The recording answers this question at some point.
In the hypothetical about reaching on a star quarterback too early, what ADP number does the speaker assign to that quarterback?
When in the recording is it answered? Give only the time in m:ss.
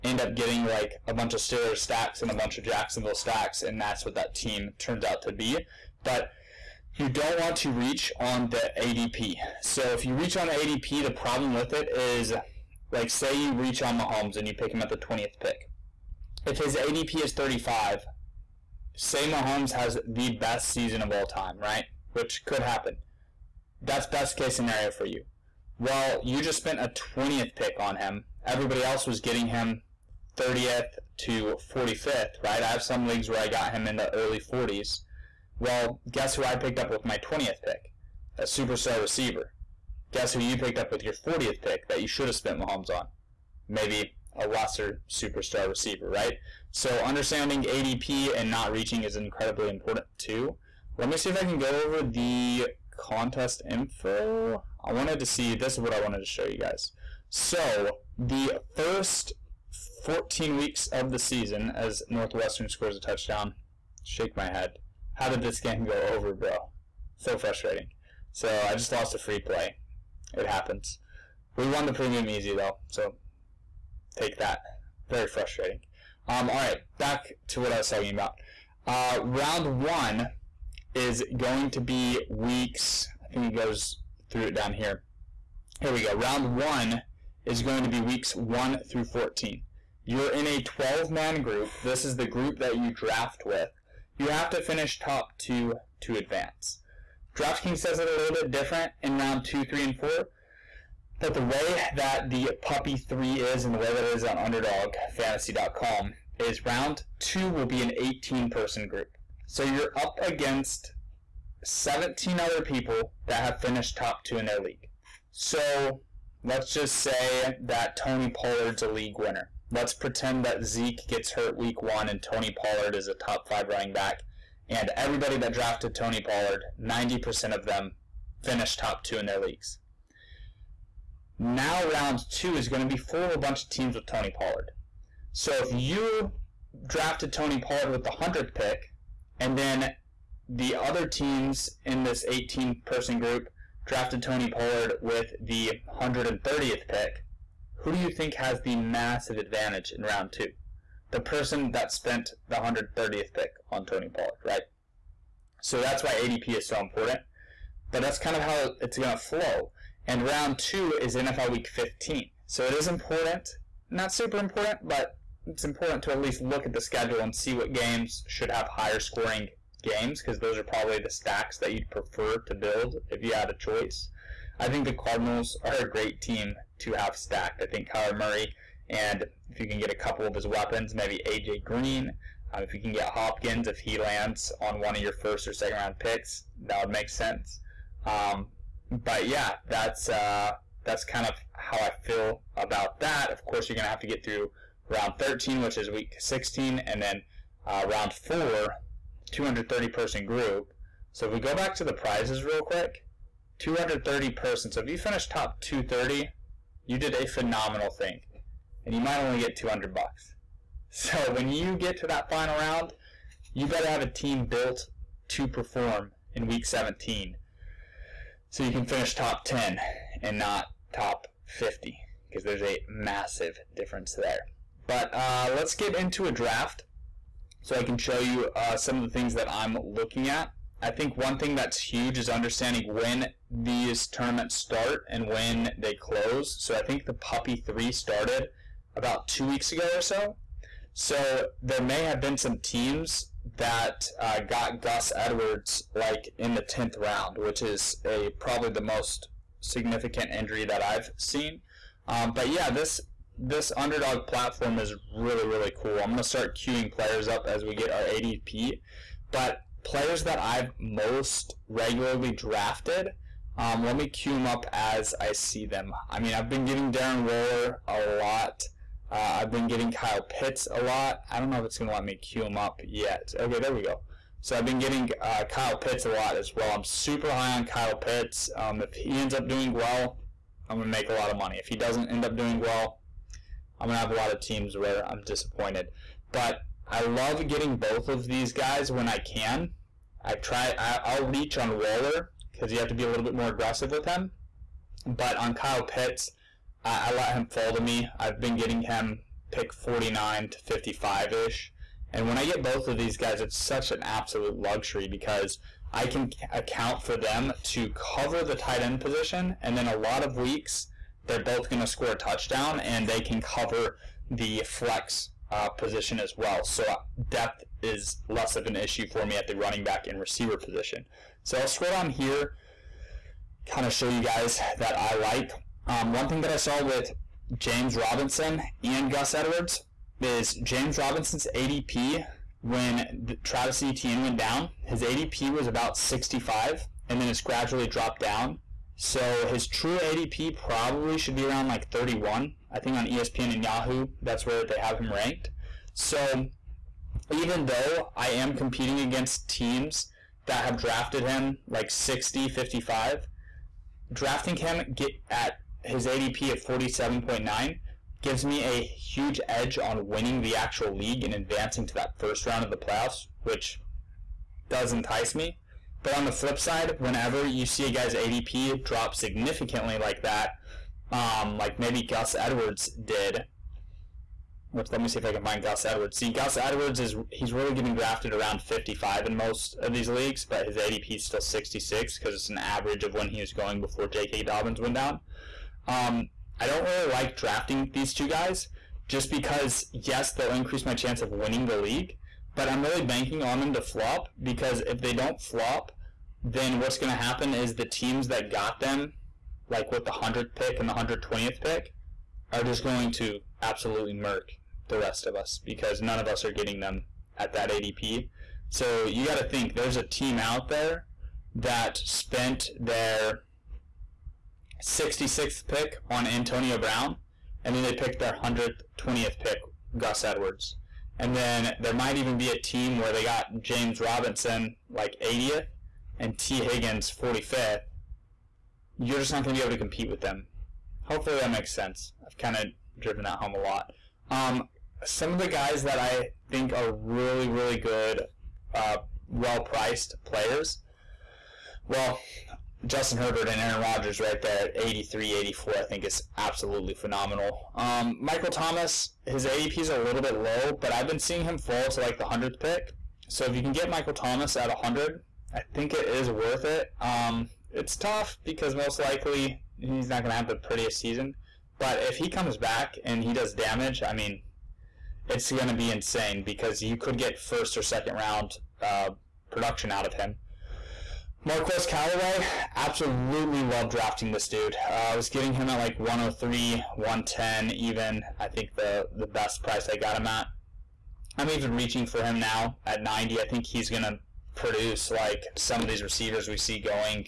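0:17.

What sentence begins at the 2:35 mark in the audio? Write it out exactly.
So that's why ADP is so important.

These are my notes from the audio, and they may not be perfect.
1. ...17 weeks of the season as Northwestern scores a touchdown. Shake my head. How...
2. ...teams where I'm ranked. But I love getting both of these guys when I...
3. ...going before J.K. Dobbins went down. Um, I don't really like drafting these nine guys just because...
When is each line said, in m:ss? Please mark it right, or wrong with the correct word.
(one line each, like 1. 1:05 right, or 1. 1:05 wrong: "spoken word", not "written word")
1. 1:00 wrong: "14", not "17"
2. 4:44 wrong: "disappointed", not "ranked"
3. 6:23 wrong: "two", not "nine".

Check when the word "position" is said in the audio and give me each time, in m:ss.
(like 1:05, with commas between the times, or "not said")
5:08, 5:15, 5:20.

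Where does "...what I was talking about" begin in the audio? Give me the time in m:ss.
1:17.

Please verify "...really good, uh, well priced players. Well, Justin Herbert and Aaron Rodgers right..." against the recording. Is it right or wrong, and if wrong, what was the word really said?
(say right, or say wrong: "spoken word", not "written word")
right.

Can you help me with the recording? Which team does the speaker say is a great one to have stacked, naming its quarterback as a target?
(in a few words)
Cardinals.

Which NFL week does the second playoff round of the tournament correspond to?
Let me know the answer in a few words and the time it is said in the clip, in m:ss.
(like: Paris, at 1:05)
Week 15, at 2:41.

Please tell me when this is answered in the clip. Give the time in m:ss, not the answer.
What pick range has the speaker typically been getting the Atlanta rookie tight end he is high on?
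4:59.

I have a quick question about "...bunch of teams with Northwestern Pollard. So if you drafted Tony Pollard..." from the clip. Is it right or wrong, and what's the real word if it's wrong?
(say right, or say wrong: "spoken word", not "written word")
wrong: "Tony", not "Northwestern".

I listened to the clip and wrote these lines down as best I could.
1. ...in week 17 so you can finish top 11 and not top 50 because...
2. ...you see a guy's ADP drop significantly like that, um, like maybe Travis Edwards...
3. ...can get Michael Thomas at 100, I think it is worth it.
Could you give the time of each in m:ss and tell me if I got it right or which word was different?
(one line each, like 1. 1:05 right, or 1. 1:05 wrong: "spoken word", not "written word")
1. 3:36 wrong: "10", not "11"
2. 6:07 wrong: "Gus", not "Travis"
3. 7:33 right.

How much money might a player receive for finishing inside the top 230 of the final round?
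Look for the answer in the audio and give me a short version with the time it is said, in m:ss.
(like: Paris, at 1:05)
$200, at 3:29.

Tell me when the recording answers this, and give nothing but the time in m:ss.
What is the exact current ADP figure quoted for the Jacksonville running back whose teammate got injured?
5:56.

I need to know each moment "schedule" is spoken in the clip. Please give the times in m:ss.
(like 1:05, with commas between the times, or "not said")
2:46.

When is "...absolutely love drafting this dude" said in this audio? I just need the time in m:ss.
7:52.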